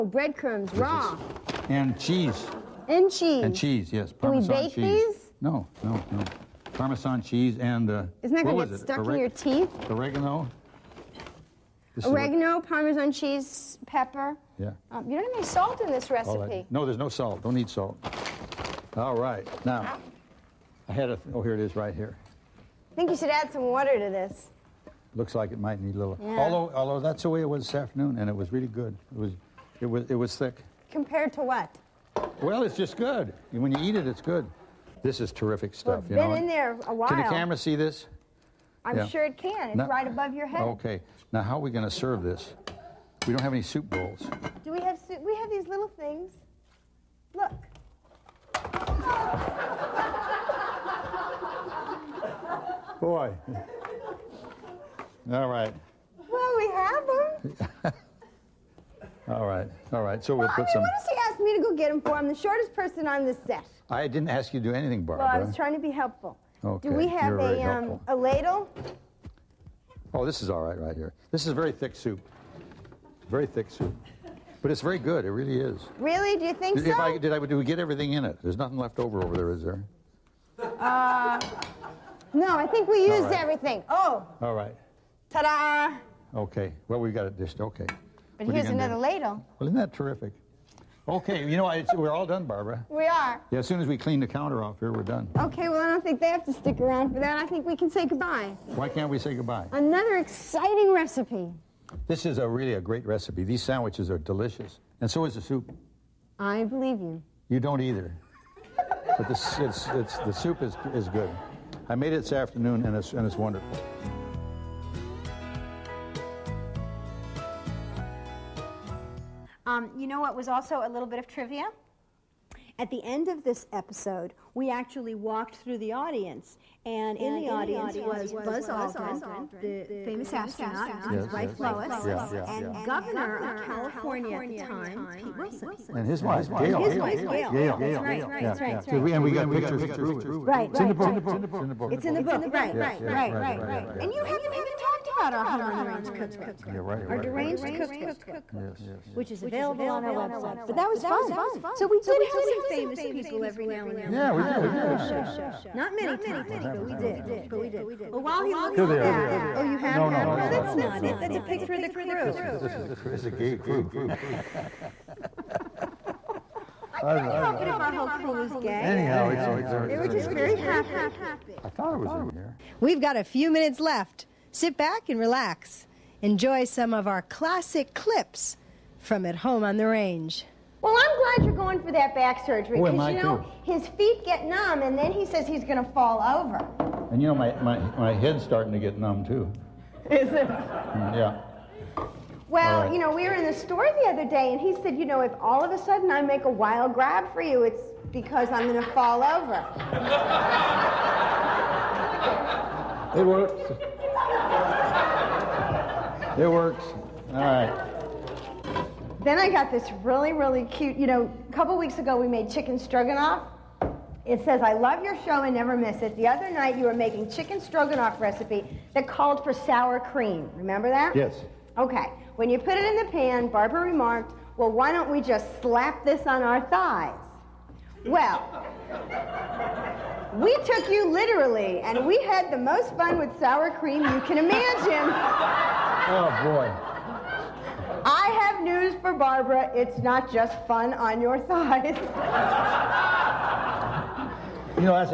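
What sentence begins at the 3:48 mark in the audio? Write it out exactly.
Well, we took you literally, and we had the most fun with sour cream you can imagine.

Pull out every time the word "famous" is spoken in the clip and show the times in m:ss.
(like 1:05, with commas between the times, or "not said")
2:10, 2:32.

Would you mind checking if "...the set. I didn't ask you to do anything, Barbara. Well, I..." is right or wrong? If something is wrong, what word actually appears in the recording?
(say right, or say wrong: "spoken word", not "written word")
right.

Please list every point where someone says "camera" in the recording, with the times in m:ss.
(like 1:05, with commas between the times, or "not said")
0:37.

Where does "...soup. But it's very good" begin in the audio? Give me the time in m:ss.
1:13.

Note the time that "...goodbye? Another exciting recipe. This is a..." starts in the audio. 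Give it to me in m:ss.
1:39.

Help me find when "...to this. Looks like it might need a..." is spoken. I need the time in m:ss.
0:23.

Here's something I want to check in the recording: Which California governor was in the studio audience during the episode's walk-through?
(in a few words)
Pete Wilson.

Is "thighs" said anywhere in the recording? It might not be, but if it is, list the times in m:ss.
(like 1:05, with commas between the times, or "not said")
3:46, 4:01.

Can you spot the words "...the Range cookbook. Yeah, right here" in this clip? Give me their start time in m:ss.
2:25.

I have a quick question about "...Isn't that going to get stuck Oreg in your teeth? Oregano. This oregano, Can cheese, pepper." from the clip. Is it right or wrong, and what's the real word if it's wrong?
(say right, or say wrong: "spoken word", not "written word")
wrong: "Parmesan", not "Can".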